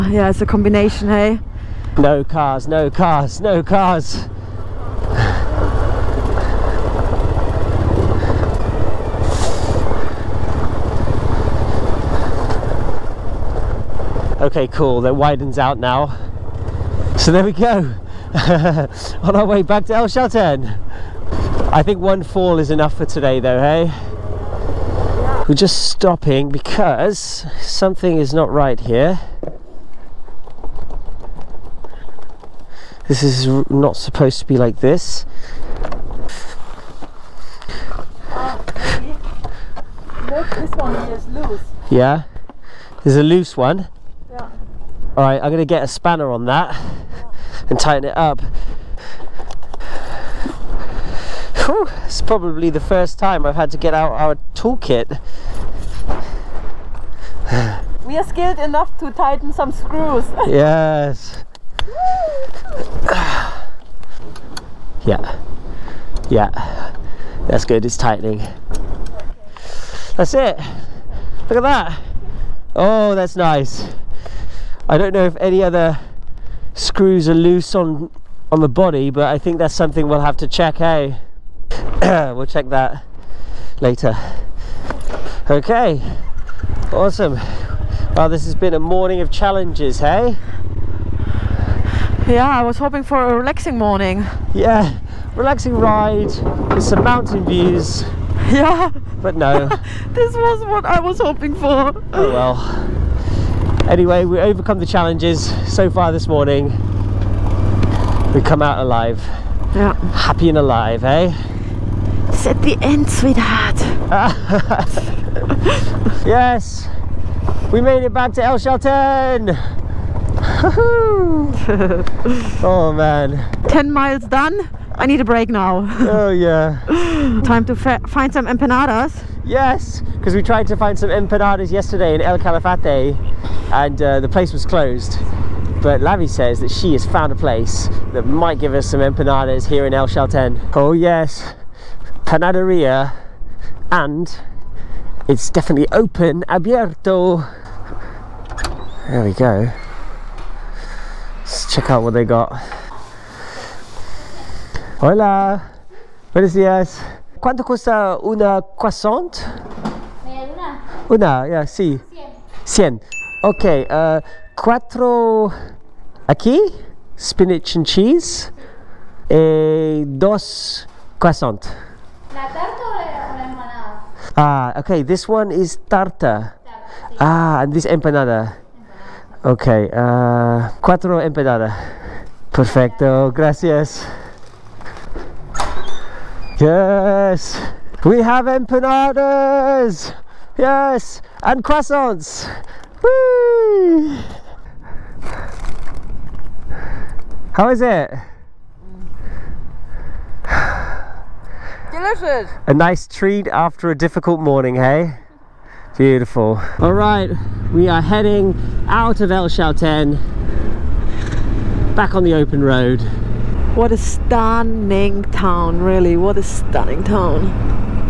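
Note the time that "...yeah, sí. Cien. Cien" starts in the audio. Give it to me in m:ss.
2:41.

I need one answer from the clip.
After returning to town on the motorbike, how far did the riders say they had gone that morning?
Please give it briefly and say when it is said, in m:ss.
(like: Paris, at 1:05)
10 miles, at 2:03.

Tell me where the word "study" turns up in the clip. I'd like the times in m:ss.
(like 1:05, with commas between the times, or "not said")
not said.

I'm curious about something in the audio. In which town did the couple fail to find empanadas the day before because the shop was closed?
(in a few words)
El Calafate.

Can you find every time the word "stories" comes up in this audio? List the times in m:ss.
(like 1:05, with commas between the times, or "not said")
not said.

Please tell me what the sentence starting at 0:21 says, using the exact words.
I think one fall is enough for today though, hey?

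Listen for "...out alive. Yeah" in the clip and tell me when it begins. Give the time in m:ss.
1:48.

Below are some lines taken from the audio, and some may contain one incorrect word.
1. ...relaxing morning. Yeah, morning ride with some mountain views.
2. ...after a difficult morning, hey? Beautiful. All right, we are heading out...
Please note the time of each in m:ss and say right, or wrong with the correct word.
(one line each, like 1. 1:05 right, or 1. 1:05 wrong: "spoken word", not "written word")
1. 1:33 wrong: "relaxing", not "morning"
2. 3:23 right.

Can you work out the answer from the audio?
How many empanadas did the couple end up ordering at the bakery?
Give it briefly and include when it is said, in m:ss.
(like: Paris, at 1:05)
4, at 3:00.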